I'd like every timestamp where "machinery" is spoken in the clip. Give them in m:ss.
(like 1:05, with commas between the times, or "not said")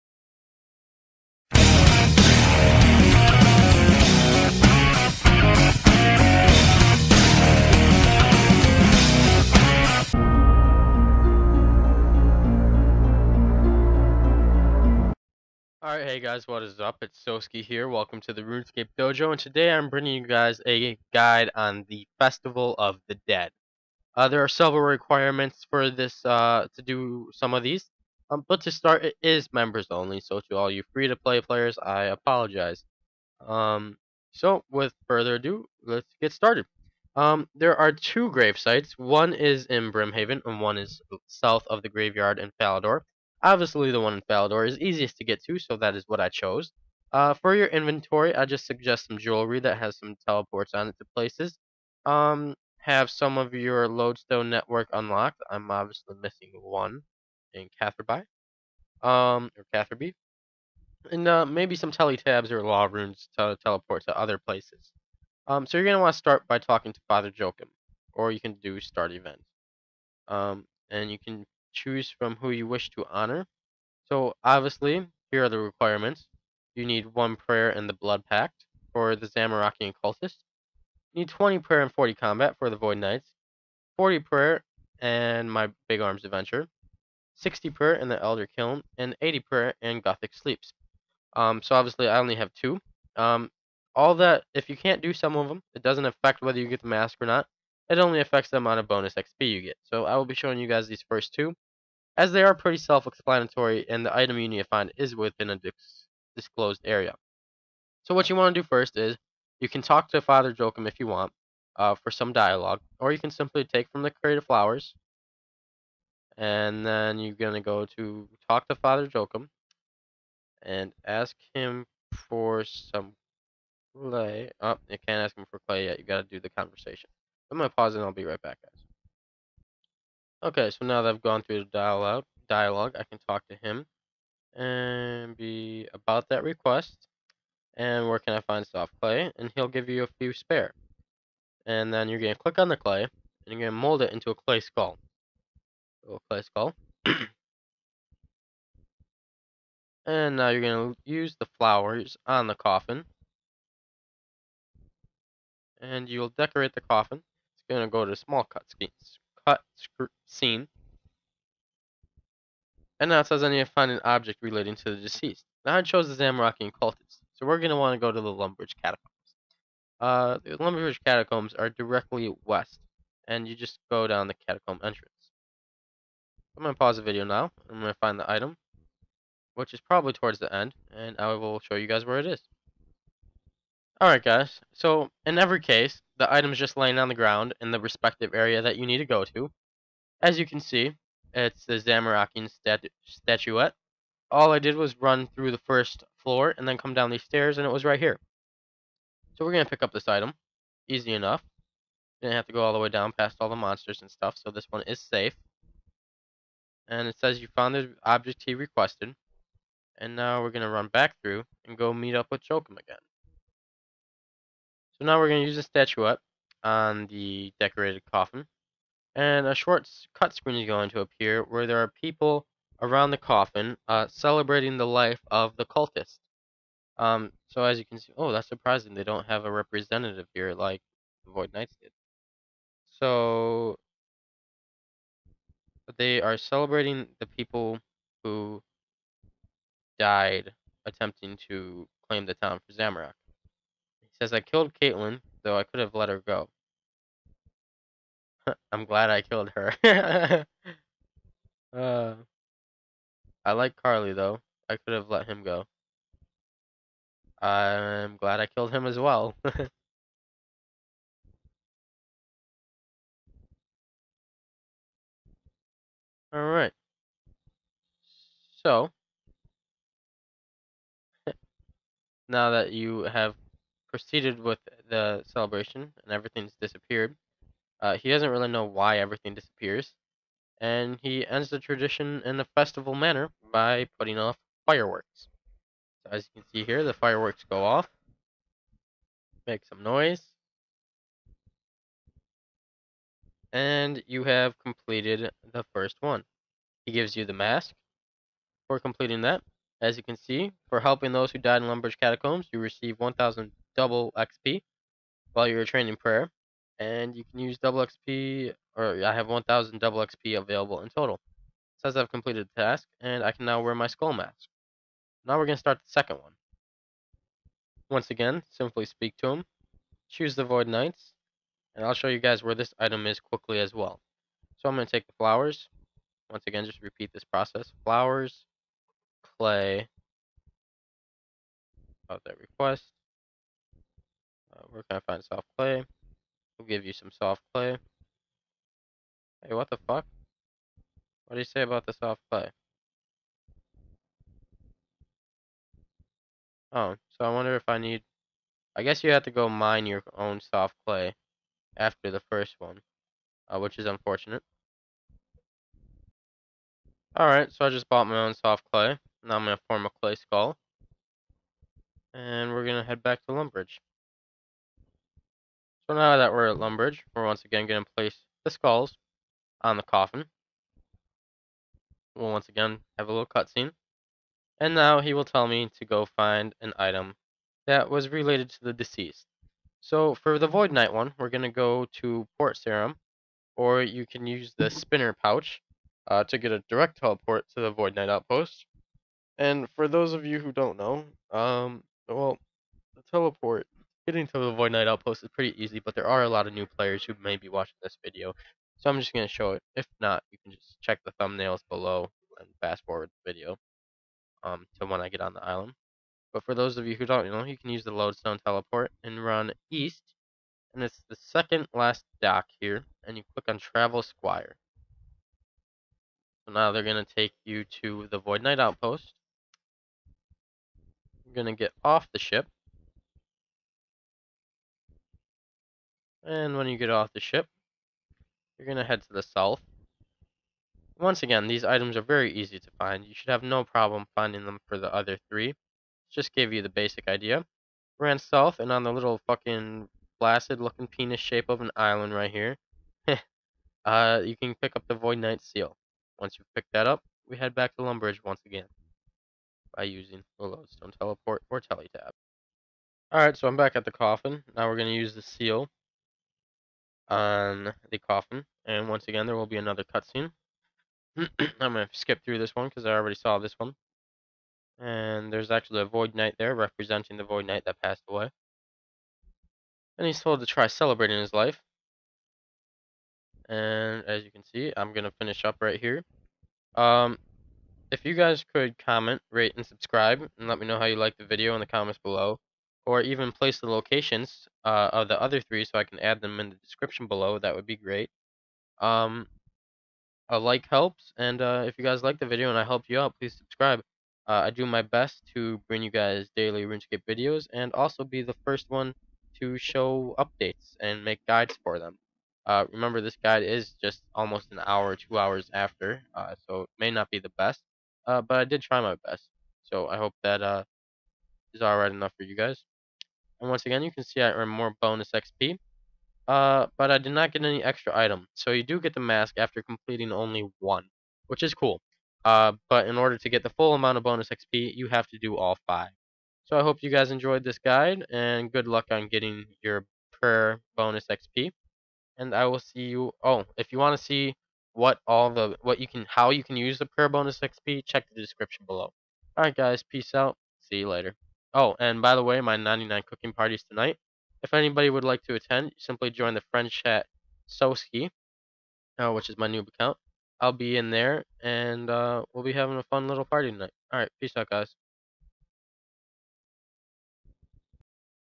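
not said.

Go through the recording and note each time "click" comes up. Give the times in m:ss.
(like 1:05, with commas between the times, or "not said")
2:22, 6:53.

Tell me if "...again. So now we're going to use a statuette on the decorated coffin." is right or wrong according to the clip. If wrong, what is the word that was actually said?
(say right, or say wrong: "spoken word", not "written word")
right.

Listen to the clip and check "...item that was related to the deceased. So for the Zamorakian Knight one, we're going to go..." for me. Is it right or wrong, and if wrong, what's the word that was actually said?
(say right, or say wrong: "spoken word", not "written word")
wrong: "Void", not "Zamorakian".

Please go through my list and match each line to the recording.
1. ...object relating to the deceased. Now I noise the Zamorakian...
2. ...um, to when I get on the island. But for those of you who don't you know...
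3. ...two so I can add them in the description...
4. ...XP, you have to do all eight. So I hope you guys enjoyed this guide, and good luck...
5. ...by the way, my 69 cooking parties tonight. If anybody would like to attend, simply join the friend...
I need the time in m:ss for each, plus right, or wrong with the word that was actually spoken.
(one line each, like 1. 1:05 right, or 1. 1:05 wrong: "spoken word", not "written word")
1. 2:44 wrong: "chose", not "noise"
2. 6:44 right
3. 8:05 wrong: "three", not "two"
4. 8:44 wrong: "five", not "eight"
5. 9:02 wrong: "99", not "69".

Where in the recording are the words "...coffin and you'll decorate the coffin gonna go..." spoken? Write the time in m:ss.
2:32.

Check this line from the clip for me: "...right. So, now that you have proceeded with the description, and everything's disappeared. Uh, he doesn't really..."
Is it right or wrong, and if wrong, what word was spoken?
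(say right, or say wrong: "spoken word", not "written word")
wrong: "celebration", not "description".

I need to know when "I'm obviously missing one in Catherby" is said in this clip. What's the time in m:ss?
0:55.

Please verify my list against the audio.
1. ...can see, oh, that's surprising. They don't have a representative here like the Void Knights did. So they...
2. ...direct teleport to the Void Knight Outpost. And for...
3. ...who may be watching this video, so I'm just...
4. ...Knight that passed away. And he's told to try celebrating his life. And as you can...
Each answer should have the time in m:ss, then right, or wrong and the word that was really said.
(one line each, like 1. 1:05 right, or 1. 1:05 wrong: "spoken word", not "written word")
1. 3:47 right
2. 6:26 right
3. 6:37 right
4. 7:47 right.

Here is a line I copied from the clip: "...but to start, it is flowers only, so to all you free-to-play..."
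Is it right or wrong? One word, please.
wrong.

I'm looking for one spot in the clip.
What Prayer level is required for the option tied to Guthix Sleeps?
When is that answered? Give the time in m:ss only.
1:29.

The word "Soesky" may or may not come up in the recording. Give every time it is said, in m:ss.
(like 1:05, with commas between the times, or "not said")
0:17, 9:07.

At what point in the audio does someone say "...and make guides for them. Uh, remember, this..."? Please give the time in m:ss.
8:20.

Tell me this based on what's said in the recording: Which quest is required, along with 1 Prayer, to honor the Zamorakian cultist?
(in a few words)
The Blood Pact.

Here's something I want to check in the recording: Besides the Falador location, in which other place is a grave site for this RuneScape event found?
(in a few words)
Brimhaven.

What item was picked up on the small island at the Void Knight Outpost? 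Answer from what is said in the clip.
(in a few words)
Void Knight seal.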